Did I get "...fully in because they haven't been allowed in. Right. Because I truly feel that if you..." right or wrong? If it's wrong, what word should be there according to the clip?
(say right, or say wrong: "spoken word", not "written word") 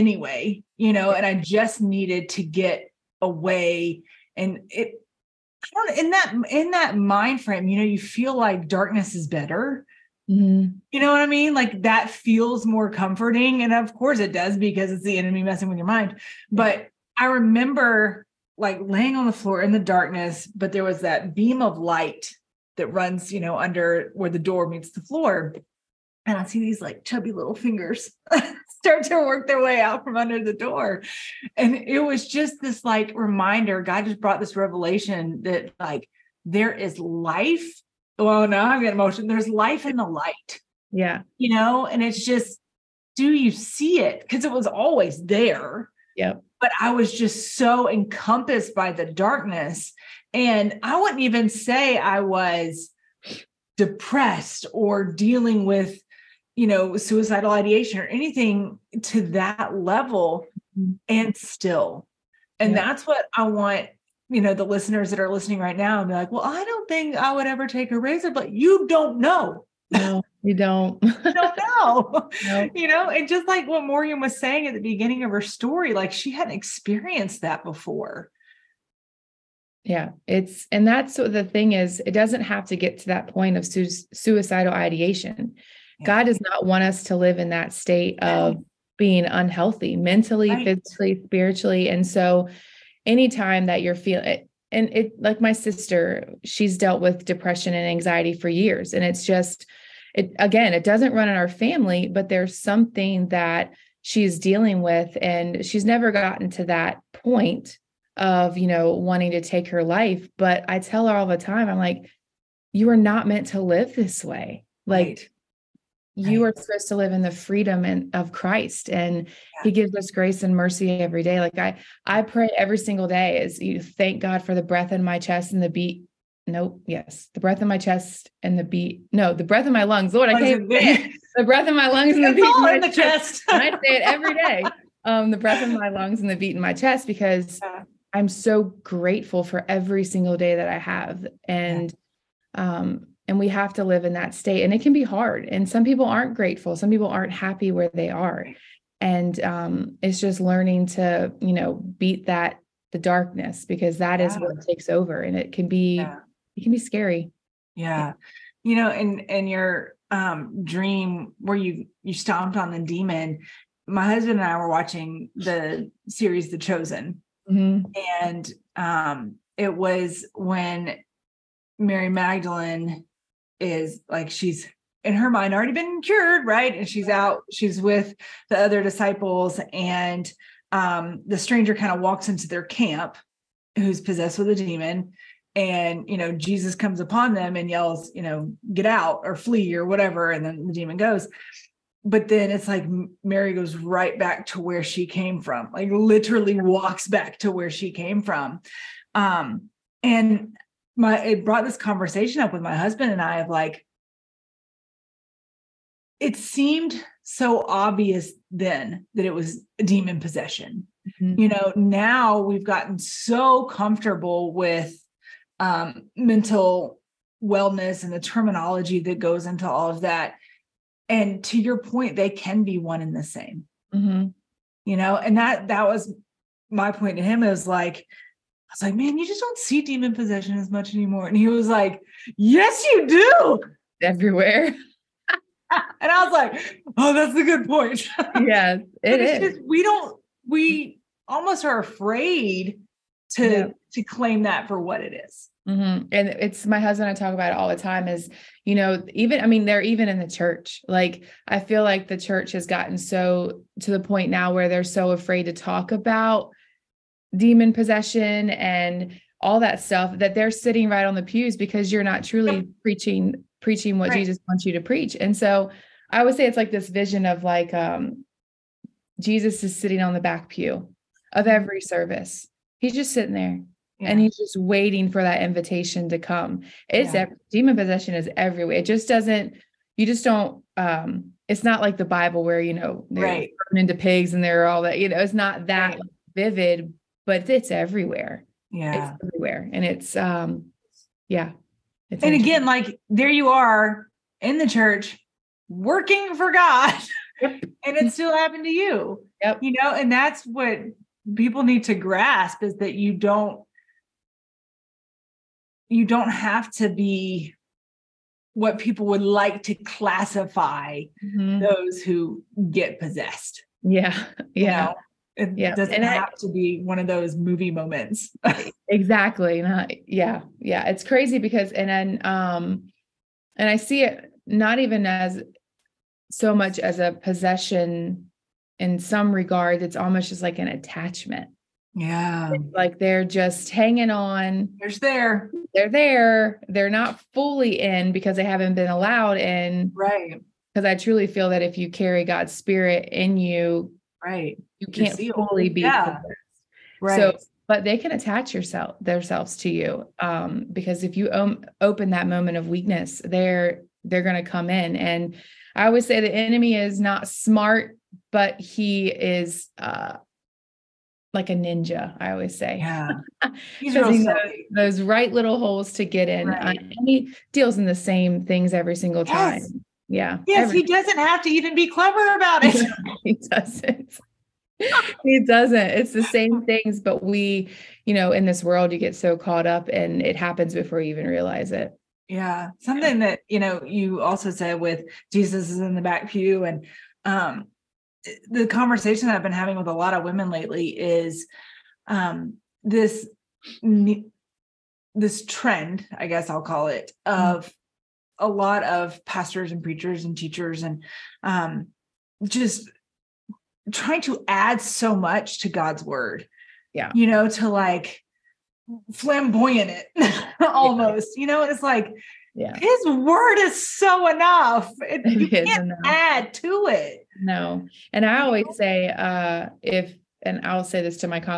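right.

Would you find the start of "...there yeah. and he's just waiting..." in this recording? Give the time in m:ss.
4:33.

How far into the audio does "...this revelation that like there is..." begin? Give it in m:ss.
0:34.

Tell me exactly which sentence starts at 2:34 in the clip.
is what takes over and it can be yeah.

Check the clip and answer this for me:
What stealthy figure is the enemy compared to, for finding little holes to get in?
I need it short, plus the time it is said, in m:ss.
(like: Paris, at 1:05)
A ninja, at 6:01.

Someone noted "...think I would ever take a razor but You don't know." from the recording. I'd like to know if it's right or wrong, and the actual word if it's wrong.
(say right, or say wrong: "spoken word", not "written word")
right.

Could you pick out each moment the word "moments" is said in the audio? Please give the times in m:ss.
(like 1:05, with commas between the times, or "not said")
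5:17, 5:52.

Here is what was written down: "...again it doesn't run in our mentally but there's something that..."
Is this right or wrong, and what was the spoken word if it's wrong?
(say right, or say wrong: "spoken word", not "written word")
wrong: "family", not "mentally".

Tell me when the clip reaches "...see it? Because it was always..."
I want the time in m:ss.
0:43.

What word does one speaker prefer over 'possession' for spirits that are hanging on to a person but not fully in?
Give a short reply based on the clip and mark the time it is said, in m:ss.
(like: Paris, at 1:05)
Attachment, at 5:30.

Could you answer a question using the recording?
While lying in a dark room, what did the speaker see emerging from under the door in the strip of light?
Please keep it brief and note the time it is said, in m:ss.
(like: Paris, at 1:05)
Chubby little fingers, at 0:27.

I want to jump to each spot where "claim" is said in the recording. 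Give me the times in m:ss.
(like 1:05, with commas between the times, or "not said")
4:04.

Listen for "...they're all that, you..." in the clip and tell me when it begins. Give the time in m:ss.
4:44.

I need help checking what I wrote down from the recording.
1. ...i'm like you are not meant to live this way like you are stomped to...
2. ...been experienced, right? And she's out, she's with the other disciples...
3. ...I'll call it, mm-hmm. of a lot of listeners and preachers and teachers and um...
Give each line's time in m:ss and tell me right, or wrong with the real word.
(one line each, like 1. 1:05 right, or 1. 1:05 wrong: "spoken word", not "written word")
1. 1:51 wrong: "supposed", not "stomped"
2. 2:55 wrong: "cured", not "experienced"
3. 6:36 wrong: "pastors", not "listeners".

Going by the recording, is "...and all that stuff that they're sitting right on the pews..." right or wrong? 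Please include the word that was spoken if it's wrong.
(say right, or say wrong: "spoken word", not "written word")
right.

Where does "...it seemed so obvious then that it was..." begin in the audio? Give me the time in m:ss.
3:26.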